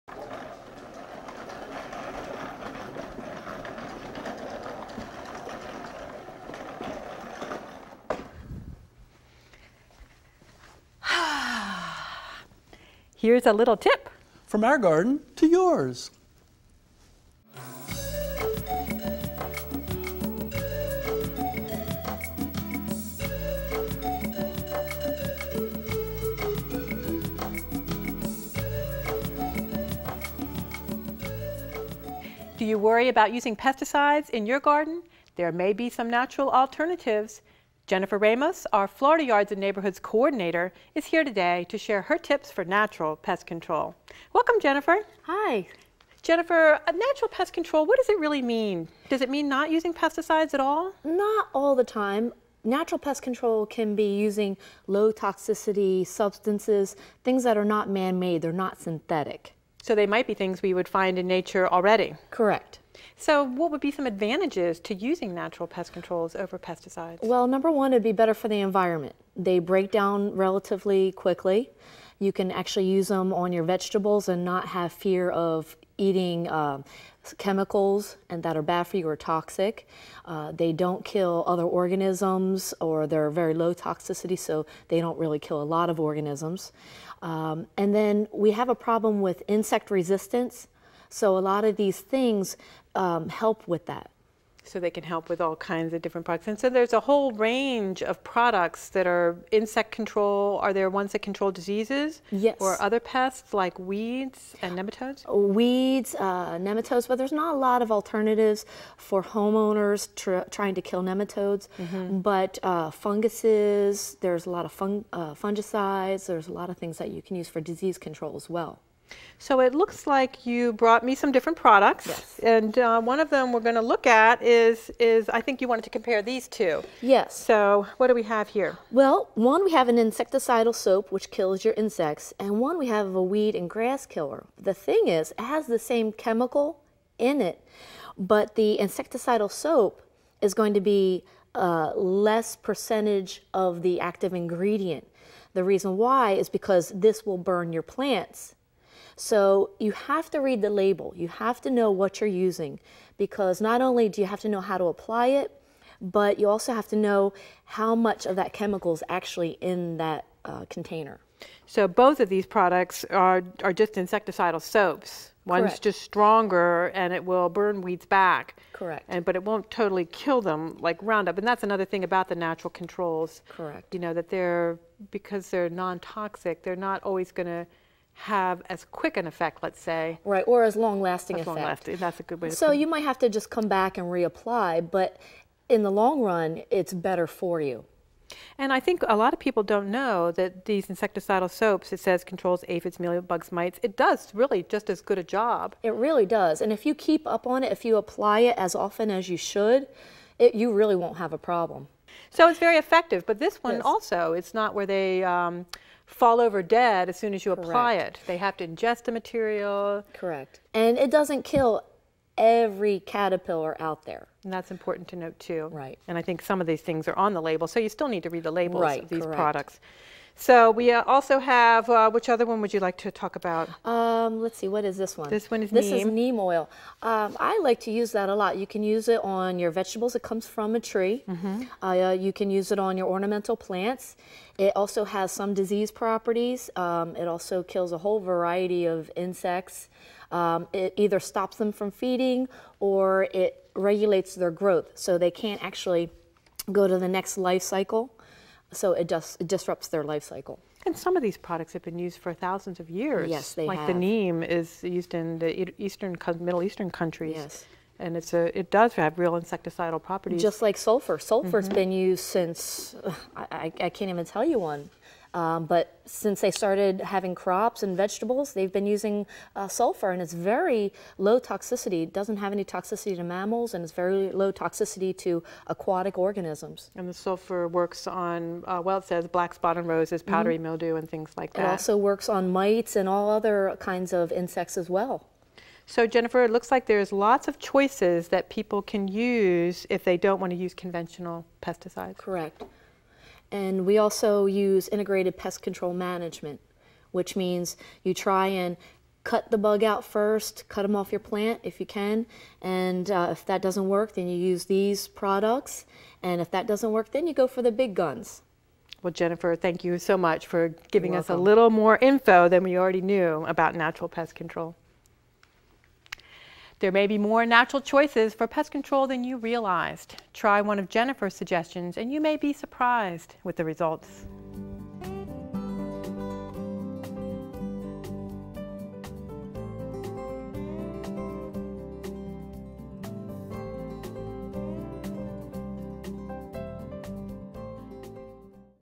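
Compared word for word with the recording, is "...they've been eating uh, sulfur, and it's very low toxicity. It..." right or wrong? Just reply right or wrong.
wrong.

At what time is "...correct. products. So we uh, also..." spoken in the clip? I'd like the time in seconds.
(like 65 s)
219 s.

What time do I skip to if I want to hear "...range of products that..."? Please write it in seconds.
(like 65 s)
97 s.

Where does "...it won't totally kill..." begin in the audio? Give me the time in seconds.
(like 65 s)
169 s.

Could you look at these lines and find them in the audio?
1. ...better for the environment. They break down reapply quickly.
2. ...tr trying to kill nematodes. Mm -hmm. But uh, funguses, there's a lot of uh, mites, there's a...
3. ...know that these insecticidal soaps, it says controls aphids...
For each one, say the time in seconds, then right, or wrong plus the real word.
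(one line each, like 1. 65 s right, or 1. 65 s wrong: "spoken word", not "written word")
1. 68 s wrong: "relatively", not "reapply"
2. 110 s wrong: "fungicides", not "mites"
3. 189 s right.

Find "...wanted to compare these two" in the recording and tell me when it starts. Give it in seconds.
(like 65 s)
125 s.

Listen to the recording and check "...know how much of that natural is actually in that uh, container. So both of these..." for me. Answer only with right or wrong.
wrong.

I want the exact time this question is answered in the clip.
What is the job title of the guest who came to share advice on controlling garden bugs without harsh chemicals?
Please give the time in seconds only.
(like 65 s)
38 s.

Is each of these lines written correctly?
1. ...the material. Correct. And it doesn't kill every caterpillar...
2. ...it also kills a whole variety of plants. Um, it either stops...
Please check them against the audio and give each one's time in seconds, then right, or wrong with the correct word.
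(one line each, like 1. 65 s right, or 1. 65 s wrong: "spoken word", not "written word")
1. 209 s right
2. 237 s wrong: "insects", not "plants".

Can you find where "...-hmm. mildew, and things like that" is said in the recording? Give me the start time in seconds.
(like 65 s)
280 s.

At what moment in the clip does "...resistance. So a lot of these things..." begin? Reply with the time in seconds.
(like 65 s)
89 s.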